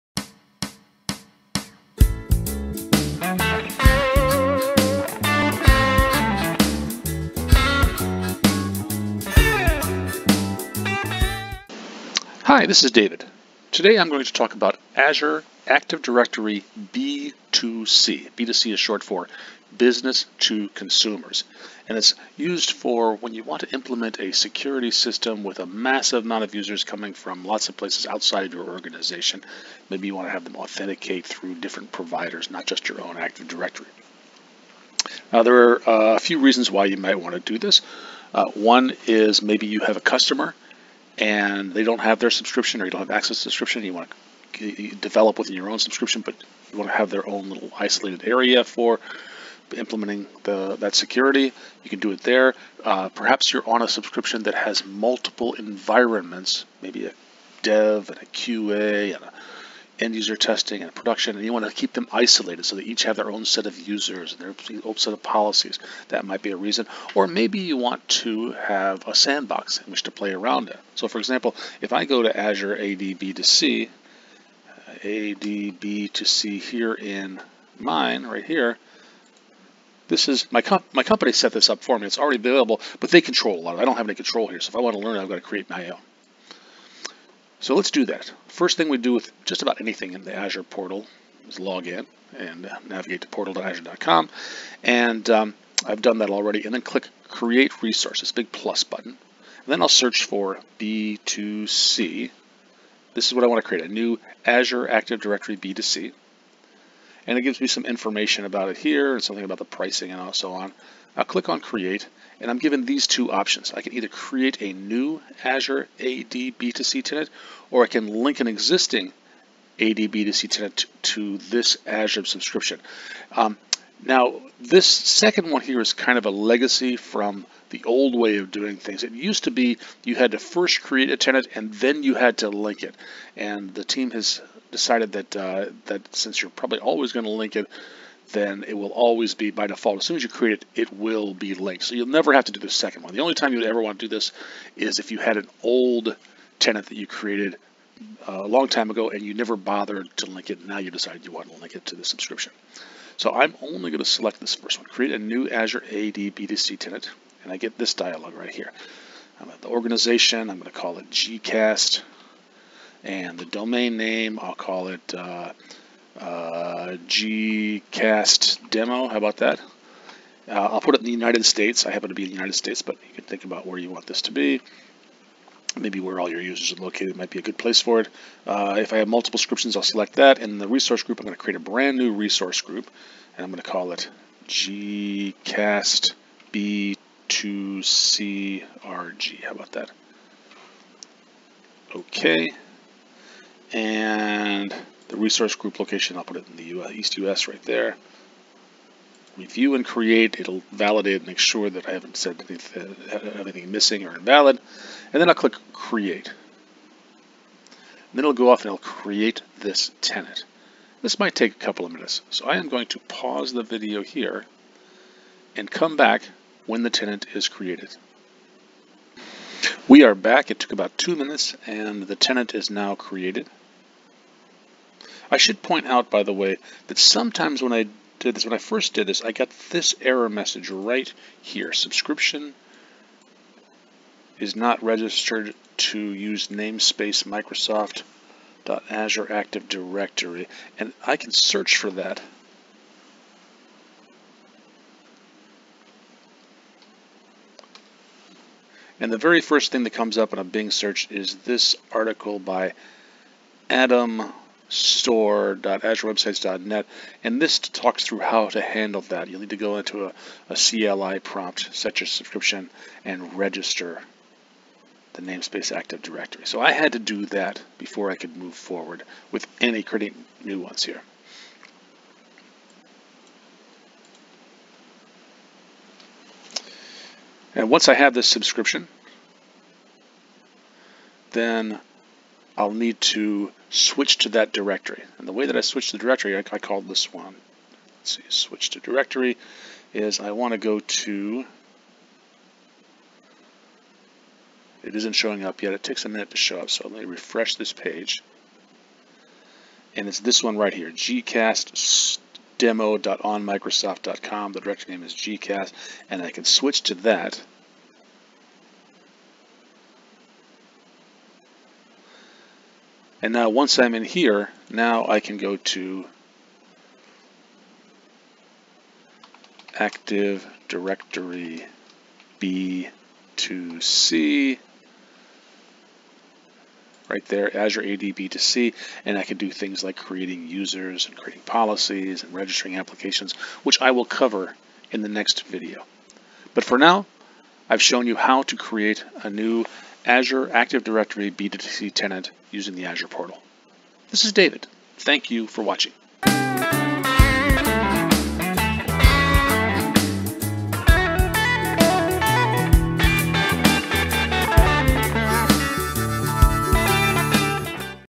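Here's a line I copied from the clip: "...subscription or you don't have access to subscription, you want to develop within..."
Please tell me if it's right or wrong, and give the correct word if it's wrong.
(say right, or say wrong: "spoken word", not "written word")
right.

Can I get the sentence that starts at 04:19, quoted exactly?
You'll need to go into a, a CLI prompt, set your subscription, and register the namespace Active Directory.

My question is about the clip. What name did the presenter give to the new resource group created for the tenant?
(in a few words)
Gcast B2CRG.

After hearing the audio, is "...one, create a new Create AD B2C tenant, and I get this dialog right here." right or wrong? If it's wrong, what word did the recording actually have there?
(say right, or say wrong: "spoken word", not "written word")
wrong: "Azure", not "Create".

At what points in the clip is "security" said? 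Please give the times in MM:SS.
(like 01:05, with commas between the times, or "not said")
00:24, 00:50.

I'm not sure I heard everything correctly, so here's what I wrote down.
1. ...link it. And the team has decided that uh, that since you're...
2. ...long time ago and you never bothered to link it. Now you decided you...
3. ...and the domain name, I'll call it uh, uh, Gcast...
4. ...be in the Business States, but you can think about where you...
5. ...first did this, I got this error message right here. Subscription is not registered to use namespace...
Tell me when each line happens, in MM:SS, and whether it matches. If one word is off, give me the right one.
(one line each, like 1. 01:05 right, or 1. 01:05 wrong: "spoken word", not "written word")
1. 02:12 right
2. 02:28 right
3. 02:43 right
4. 02:52 wrong: "United", not "Business"
5. 03:48 right.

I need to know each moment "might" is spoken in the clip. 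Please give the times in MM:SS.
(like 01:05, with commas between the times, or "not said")
00:36, 01:06, 02:57, 03:31.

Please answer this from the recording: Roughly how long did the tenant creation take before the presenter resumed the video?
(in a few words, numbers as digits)
About two minutes.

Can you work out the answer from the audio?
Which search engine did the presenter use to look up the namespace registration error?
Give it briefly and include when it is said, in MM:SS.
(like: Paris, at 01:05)
Bing, at 04:10.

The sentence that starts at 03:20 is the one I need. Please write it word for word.
It'll validate and make sure that I haven't said anything, anything missing or invalid.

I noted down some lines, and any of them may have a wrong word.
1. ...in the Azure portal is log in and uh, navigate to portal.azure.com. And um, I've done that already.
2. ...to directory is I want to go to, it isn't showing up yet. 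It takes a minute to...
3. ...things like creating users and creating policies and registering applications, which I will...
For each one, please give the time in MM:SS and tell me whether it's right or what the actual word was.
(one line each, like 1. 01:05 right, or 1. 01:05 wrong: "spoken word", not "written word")
1. 01:30 right
2. 04:48 right
3. 05:29 right.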